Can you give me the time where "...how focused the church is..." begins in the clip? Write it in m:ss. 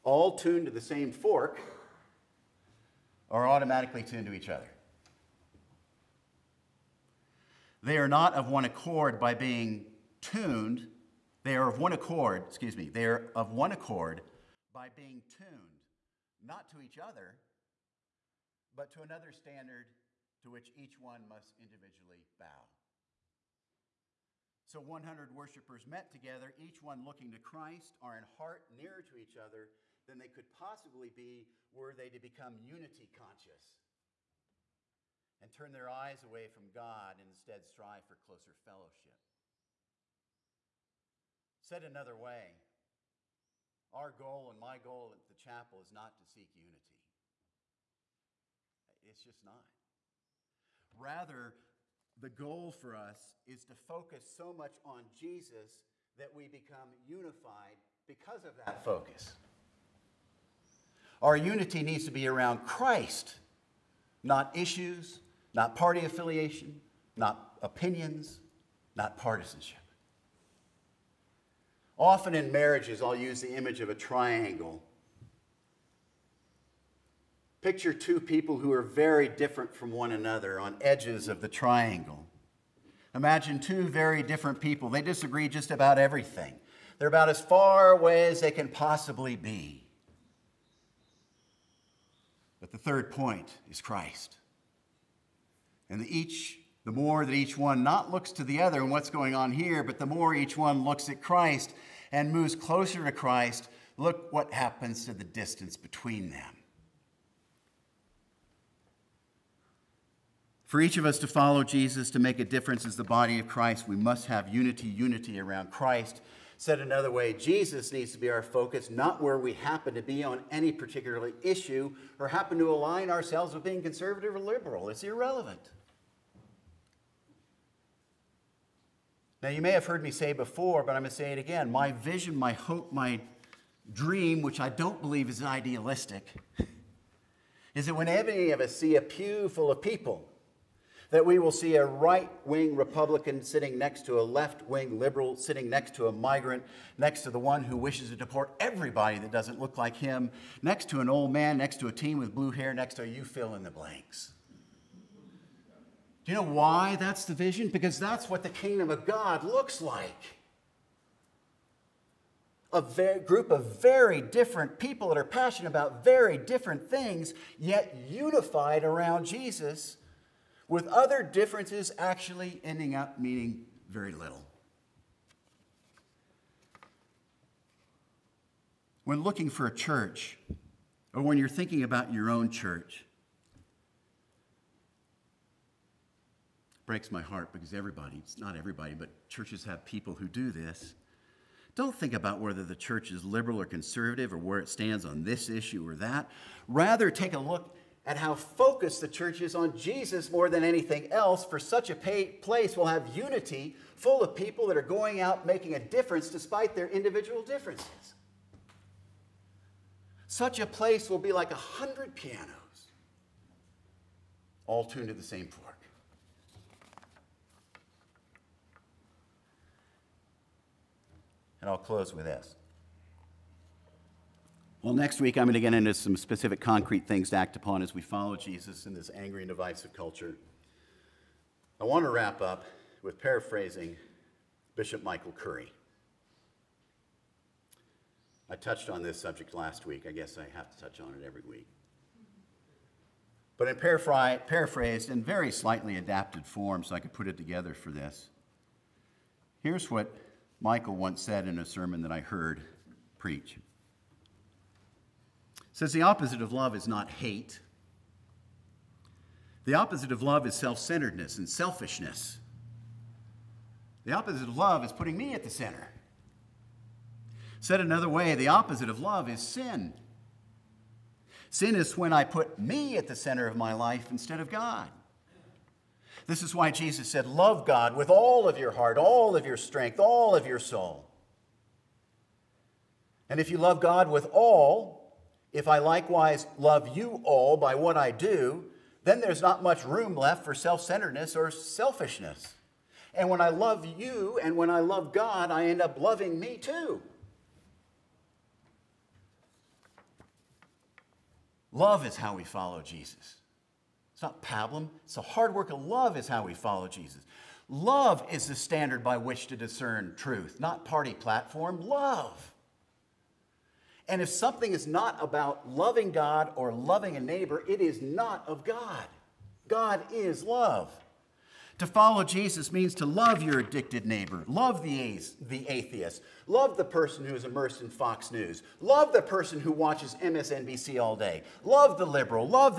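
3:18.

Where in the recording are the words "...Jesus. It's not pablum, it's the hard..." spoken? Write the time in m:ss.
5:02.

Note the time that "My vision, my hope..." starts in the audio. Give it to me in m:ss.
2:11.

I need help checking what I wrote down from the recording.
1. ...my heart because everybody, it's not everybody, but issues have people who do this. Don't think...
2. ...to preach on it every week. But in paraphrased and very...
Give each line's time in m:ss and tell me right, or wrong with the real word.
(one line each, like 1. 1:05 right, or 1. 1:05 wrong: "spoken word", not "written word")
1. 3:07 wrong: "churches", not "issues"
2. 4:00 wrong: "touch", not "preach".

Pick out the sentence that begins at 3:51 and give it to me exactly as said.
I want to wrap up with paraphrasing Bishop Michael Curry.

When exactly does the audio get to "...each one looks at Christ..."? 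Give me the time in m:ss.
1:40.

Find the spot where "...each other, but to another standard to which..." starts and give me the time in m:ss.
0:16.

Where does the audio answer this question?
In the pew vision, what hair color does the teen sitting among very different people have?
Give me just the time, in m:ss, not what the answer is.
2:32.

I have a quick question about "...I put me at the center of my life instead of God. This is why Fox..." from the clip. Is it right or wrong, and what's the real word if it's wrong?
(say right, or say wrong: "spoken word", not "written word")
wrong: "Jesus", not "Fox".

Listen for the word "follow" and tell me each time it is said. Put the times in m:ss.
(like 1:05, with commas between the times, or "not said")
1:51, 3:48, 5:02, 5:06, 5:21.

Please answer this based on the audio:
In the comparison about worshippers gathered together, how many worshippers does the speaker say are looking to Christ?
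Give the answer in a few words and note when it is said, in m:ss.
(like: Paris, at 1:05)
100, at 0:24.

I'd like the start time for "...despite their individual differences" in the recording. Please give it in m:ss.
3:26.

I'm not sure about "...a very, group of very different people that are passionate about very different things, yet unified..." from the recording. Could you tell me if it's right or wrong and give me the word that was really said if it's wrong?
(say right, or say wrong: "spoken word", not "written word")
right.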